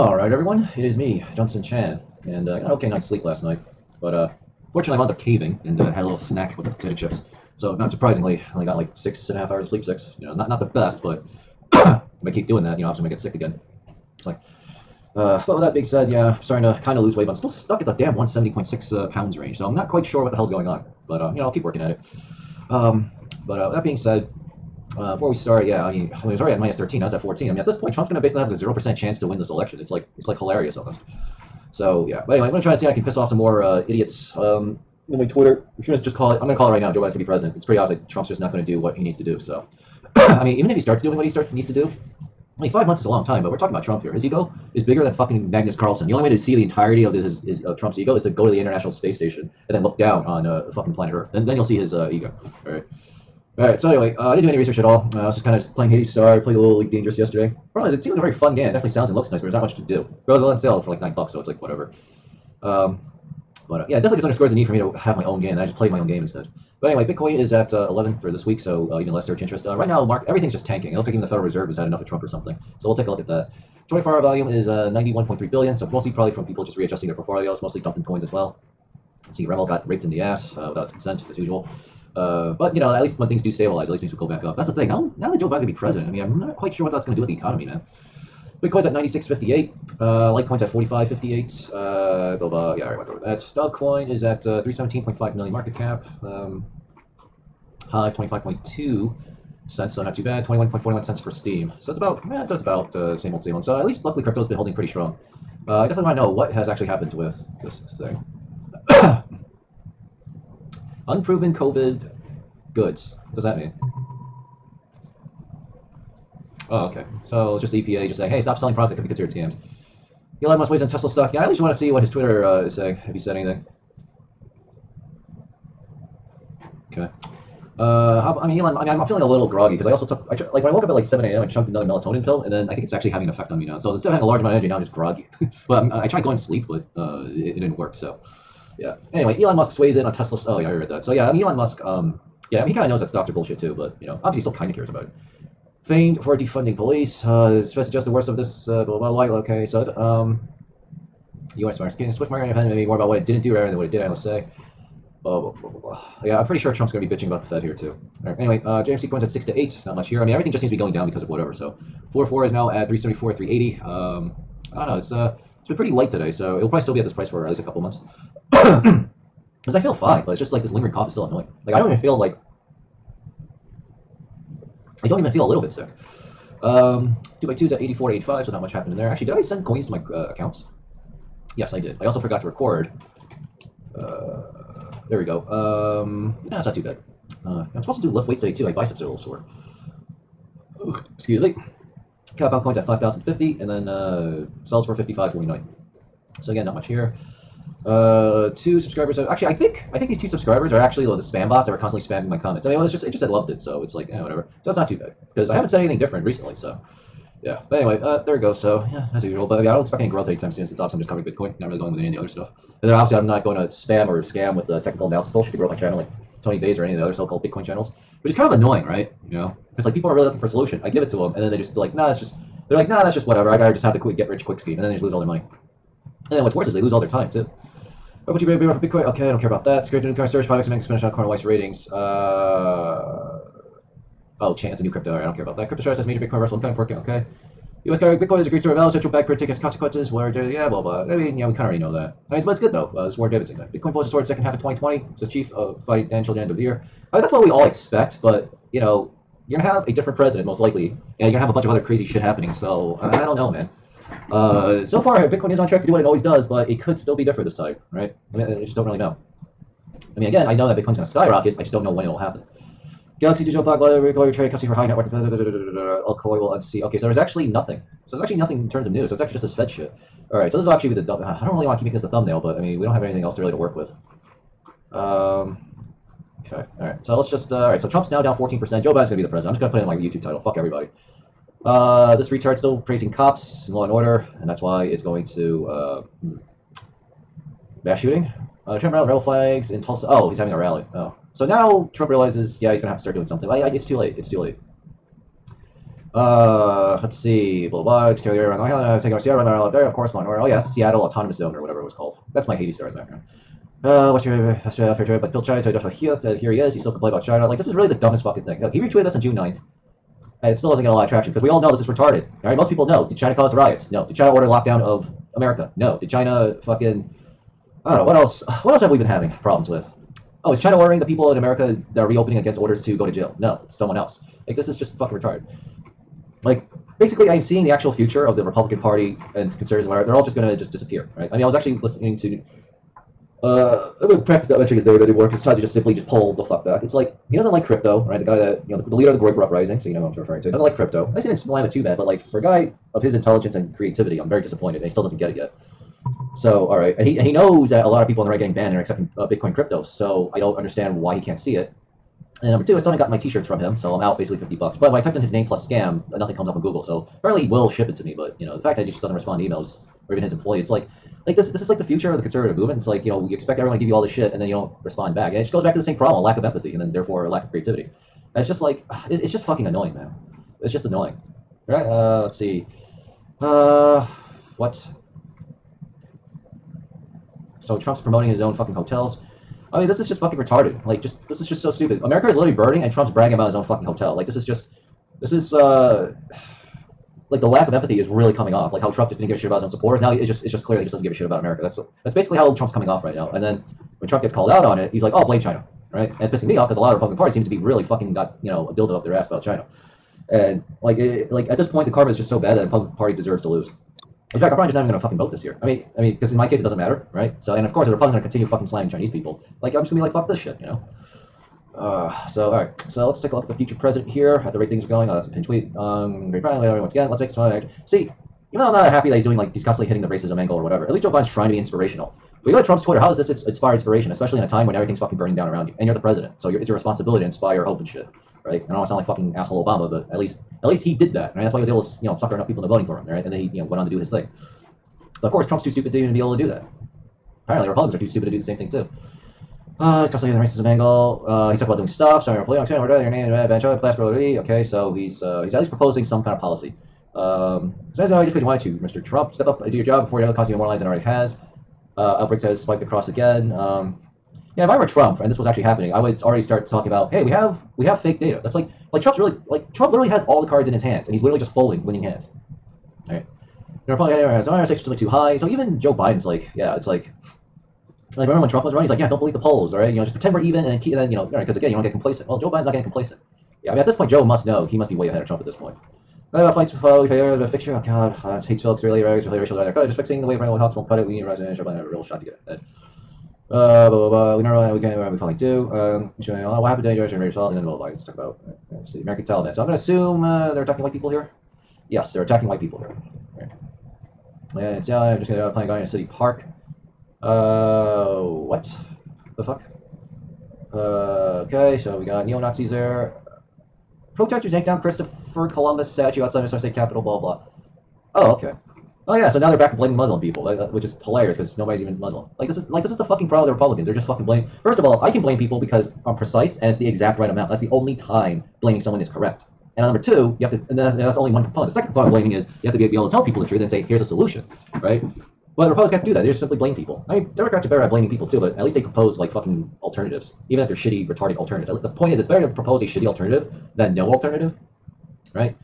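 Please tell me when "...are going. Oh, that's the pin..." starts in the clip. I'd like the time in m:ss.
6:54.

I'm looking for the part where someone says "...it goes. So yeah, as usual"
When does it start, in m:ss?
3:28.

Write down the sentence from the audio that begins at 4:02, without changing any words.
I mean, but it's good though.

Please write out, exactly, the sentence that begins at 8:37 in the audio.
That's the only time blaming someone is correct.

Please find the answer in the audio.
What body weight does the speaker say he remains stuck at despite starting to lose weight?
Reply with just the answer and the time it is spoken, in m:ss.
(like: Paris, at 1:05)
170.6 pounds, at 0:18.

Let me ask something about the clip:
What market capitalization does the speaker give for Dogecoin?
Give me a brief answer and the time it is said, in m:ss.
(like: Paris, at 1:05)
317.5 million, at 1:34.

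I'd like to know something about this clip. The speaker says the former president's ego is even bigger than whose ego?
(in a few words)
Magnus Carlsen.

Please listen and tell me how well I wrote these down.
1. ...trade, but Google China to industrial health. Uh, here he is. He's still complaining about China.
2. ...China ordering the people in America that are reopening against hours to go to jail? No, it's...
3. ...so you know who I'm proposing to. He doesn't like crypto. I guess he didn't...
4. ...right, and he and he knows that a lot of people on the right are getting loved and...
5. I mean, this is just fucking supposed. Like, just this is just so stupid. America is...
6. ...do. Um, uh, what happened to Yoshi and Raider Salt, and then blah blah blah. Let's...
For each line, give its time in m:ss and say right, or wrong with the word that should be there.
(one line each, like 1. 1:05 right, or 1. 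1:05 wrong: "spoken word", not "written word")
1. 5:05 wrong: "Bill", not "Google"
2. 5:20 wrong: "orders", not "hours"
3. 5:39 wrong: "referring", not "proposing"
4. 5:46 wrong: "banned", not "loved"
5. 6:19 wrong: "retarded", not "supposed"
6. 8:05 right.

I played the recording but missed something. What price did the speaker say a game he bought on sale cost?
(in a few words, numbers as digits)
9 dollars.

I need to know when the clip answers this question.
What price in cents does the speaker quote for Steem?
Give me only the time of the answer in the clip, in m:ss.
1:40.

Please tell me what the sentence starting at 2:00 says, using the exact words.
Elon Musk weighs on Tesla stock.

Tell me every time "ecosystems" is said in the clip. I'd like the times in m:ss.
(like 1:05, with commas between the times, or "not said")
not said.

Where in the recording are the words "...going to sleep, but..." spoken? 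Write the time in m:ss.
2:16.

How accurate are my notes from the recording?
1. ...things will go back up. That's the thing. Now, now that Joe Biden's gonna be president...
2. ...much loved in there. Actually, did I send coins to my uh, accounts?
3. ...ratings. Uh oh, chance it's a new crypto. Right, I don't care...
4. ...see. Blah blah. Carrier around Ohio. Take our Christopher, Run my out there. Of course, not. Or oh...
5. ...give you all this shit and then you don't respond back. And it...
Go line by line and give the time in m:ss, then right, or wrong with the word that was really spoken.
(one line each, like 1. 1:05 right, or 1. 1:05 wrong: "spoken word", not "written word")
1. 1:24 right
2. 2:58 wrong: "happened", not "loved"
3. 3:51 right
4. 4:57 wrong: "Seattle", not "Christopher"
5. 6:03 right.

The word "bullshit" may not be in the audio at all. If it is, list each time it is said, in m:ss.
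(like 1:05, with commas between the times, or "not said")
2:23, 3:35.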